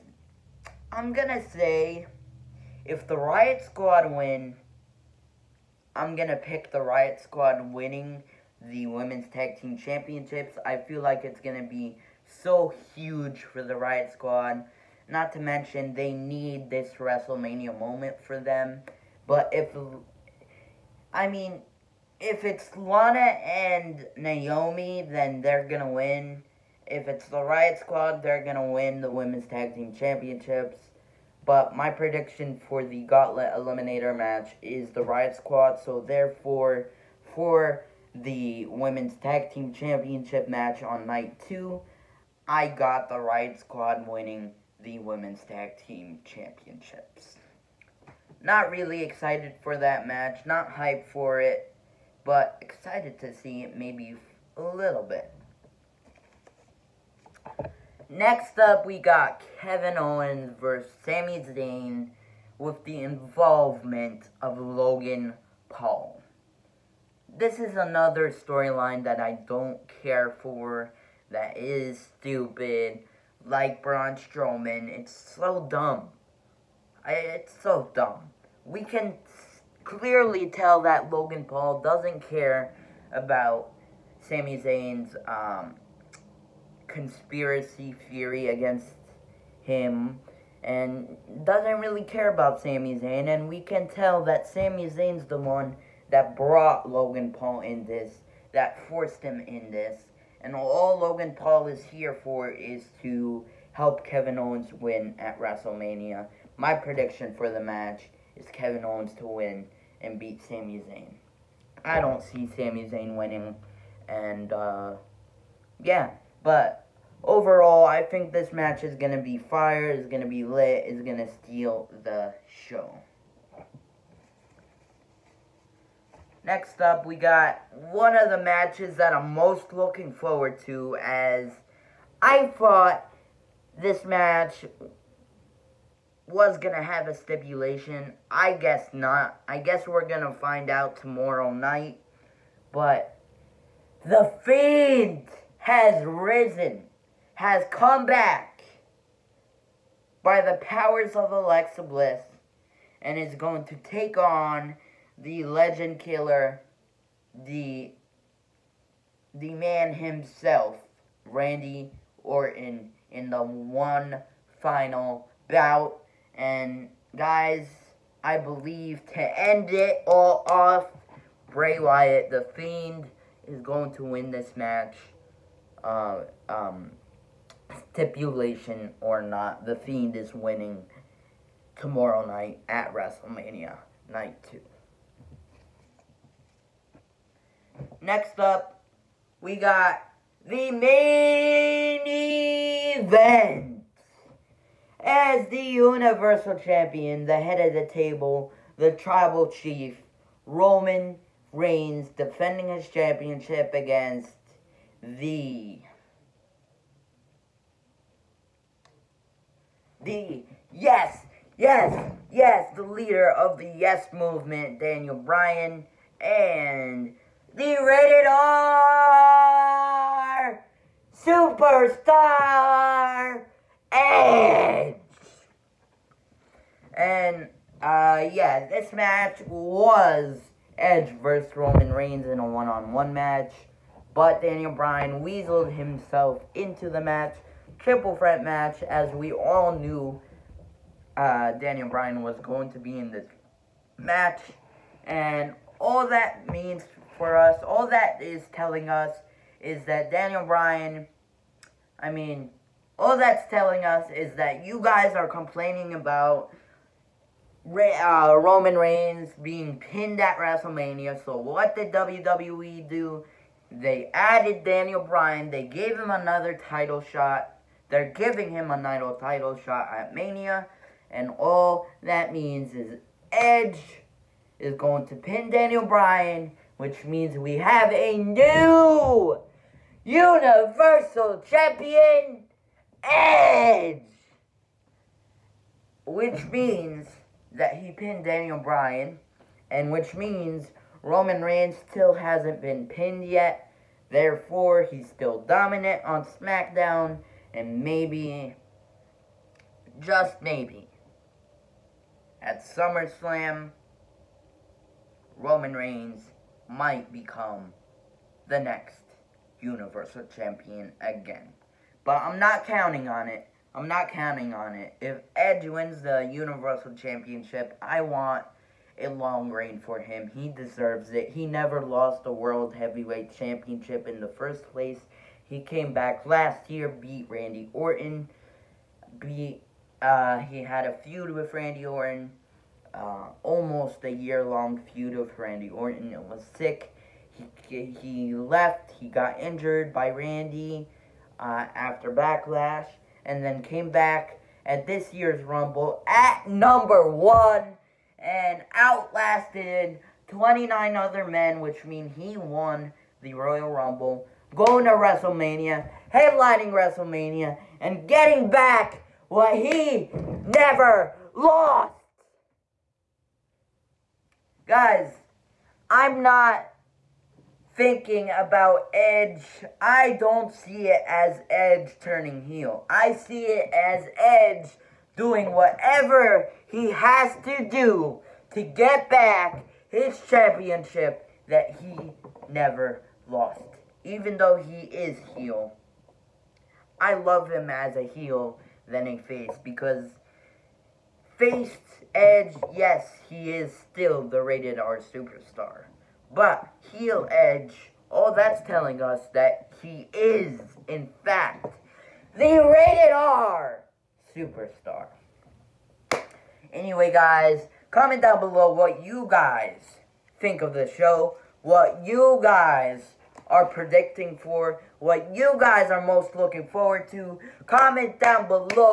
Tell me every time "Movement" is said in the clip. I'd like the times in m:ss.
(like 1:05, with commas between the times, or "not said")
3:34.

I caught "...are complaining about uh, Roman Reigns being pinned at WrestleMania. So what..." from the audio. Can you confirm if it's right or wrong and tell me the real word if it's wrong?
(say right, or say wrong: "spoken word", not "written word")
right.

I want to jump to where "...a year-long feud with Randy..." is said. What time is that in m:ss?
5:34.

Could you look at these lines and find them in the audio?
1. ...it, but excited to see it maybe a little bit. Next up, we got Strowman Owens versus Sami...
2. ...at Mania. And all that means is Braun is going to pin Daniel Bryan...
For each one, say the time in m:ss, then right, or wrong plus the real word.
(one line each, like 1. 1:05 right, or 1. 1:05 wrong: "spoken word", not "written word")
1. 0:51 wrong: "Kevin", not "Strowman"
2. 4:29 wrong: "Edge", not "Braun".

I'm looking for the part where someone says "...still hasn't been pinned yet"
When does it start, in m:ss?
4:51.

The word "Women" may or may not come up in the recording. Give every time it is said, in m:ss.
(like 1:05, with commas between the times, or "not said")
0:08, 0:29, 0:38, 0:44.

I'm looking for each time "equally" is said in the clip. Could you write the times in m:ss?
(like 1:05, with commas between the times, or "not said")
not said.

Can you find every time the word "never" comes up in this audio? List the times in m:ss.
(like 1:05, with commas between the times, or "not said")
5:21, 6:00, 6:22.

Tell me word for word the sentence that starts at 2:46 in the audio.
And guys, I believe to end it all off, Bray Wyatt, the Fiend, is going to win this match.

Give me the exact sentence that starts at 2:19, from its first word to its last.
I guess we're going to find out tomorrow night.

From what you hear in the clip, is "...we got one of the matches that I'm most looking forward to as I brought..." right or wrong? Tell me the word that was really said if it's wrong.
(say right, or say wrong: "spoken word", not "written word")
wrong: "thought", not "brought".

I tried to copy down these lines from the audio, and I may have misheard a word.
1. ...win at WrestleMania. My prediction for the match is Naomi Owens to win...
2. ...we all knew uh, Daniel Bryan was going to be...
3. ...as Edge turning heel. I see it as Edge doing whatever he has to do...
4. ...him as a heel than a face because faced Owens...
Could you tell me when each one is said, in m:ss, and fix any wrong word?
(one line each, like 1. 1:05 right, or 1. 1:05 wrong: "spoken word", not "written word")
1. 1:44 wrong: "Kevin", not "Naomi"
2. 3:59 right
3. 6:11 right
4. 6:27 wrong: "Edge", not "Owens".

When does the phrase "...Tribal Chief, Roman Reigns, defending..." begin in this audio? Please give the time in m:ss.
3:18.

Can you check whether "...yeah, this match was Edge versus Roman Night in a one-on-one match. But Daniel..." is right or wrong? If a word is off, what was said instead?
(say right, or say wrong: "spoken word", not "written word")
wrong: "Reigns", not "Night".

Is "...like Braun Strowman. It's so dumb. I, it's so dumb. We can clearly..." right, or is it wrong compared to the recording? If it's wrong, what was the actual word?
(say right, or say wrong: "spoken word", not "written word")
right.